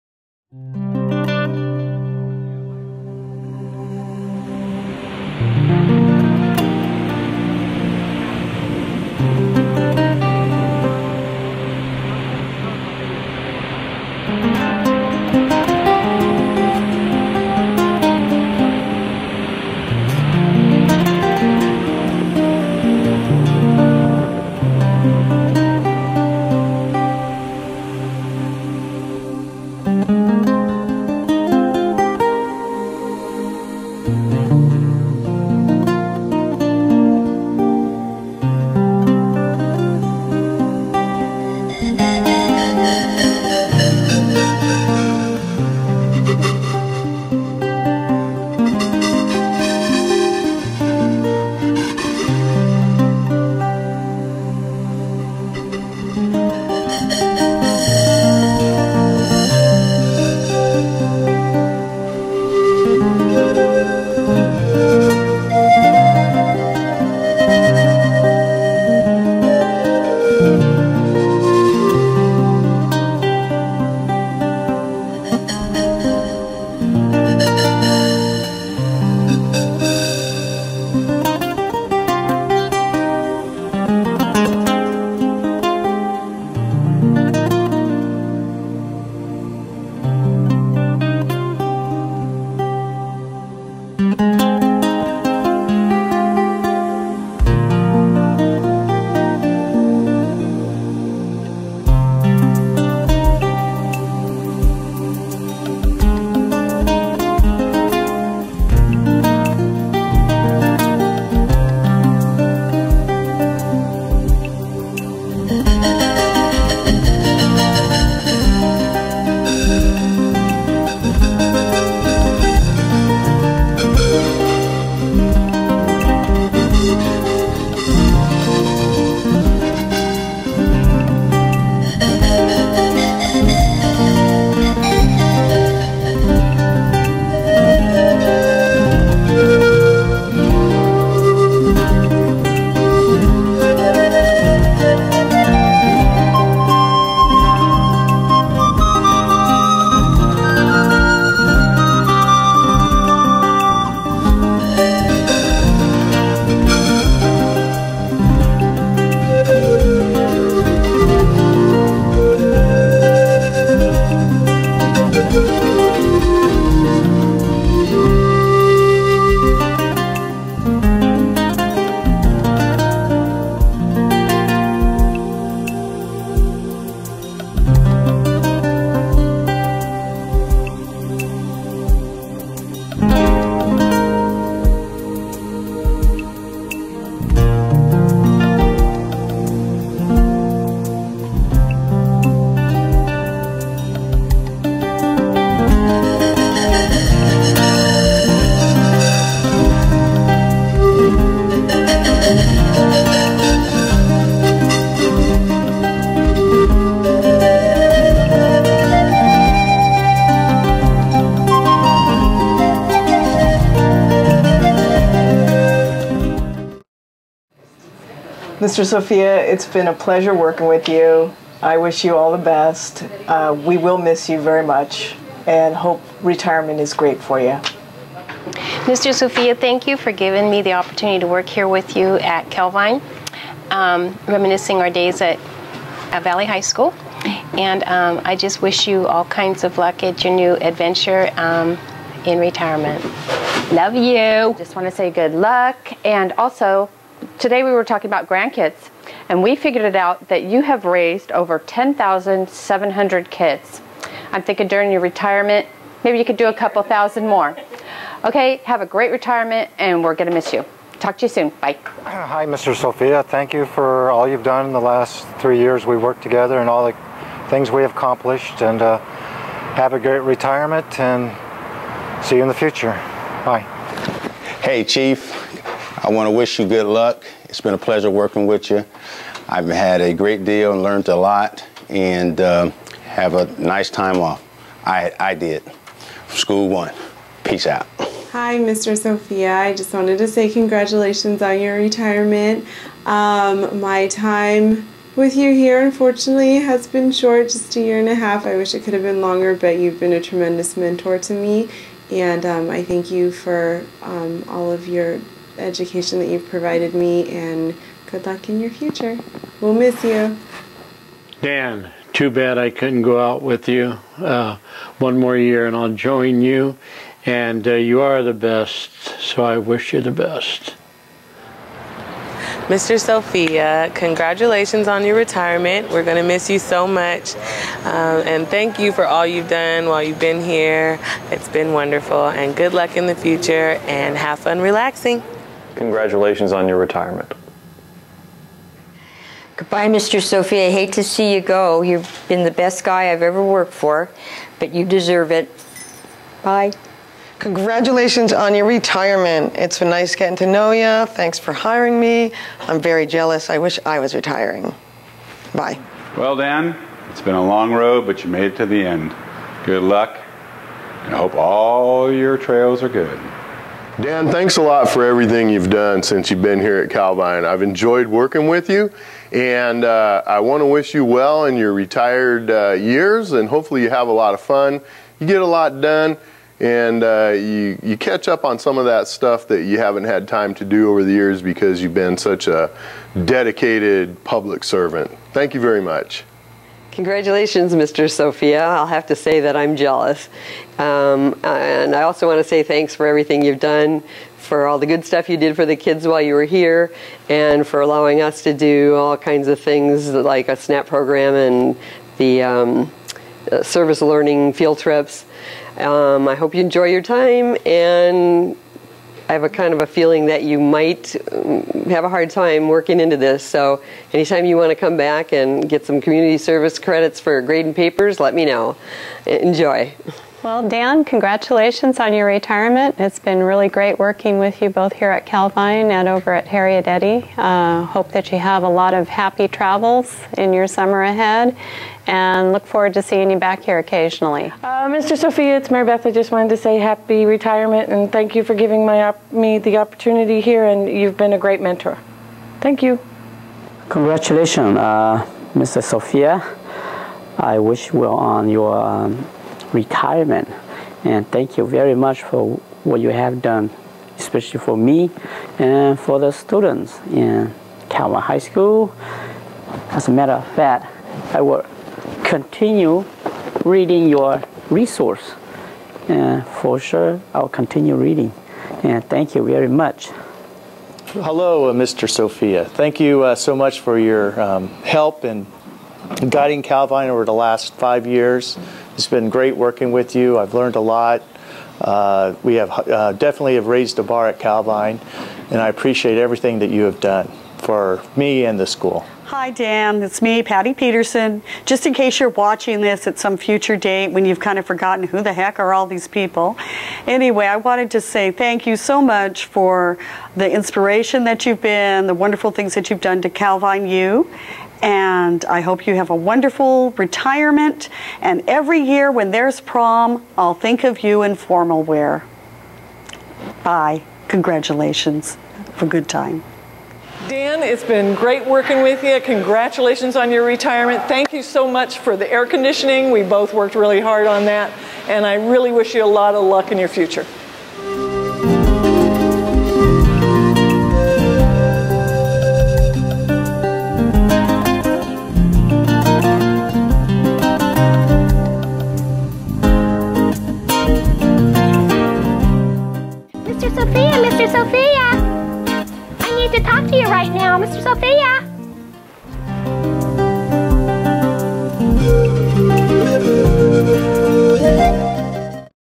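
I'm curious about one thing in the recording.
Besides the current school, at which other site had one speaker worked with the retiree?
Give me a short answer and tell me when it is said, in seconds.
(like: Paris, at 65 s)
Harriet Eddy, at 426 s.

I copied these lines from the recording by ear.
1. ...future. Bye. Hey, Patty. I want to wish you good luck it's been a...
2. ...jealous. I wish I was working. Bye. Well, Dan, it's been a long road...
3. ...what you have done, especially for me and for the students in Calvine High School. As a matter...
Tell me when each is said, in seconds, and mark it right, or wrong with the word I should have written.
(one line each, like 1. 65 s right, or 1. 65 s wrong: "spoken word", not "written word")
1. 272 s wrong: "Chief", not "Patty"
2. 353 s wrong: "retiring", not "working"
3. 452 s right.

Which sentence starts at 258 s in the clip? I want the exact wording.
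Okay, have a great retirement, and we're going to miss you.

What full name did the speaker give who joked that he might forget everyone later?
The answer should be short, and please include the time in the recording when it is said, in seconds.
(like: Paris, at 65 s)
Patty Peterson, at 490 s.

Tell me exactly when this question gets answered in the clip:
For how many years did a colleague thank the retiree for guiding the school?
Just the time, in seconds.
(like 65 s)
477 s.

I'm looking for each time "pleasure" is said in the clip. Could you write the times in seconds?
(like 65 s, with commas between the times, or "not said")
219 s, 277 s.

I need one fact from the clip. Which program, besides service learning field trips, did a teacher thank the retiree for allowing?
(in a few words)
SNAP program.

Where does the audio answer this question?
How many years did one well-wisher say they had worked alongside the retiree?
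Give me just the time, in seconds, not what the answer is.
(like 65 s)
265 s.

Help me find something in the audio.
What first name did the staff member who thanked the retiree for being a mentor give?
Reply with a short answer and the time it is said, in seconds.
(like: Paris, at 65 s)
Mary Beth, at 435 s.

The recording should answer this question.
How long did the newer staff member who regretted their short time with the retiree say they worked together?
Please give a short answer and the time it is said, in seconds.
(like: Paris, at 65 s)
A year and a half, at 297 s.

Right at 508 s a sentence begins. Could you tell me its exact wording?
And every year when there's prom, I'll think of you in formal wear.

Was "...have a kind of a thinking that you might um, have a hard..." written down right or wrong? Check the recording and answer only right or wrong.
wrong.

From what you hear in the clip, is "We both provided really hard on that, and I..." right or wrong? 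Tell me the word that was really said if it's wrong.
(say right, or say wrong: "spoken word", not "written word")
wrong: "worked", not "provided".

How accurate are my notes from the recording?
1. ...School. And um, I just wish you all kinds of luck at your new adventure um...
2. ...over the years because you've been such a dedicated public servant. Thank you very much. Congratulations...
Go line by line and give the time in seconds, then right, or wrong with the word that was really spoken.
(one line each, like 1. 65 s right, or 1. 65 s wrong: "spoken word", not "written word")
1. 236 s right
2. 380 s right.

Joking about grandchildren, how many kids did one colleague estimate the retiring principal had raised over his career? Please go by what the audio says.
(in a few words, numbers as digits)
10,700.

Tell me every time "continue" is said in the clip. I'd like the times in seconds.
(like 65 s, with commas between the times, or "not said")
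462 s, 467 s.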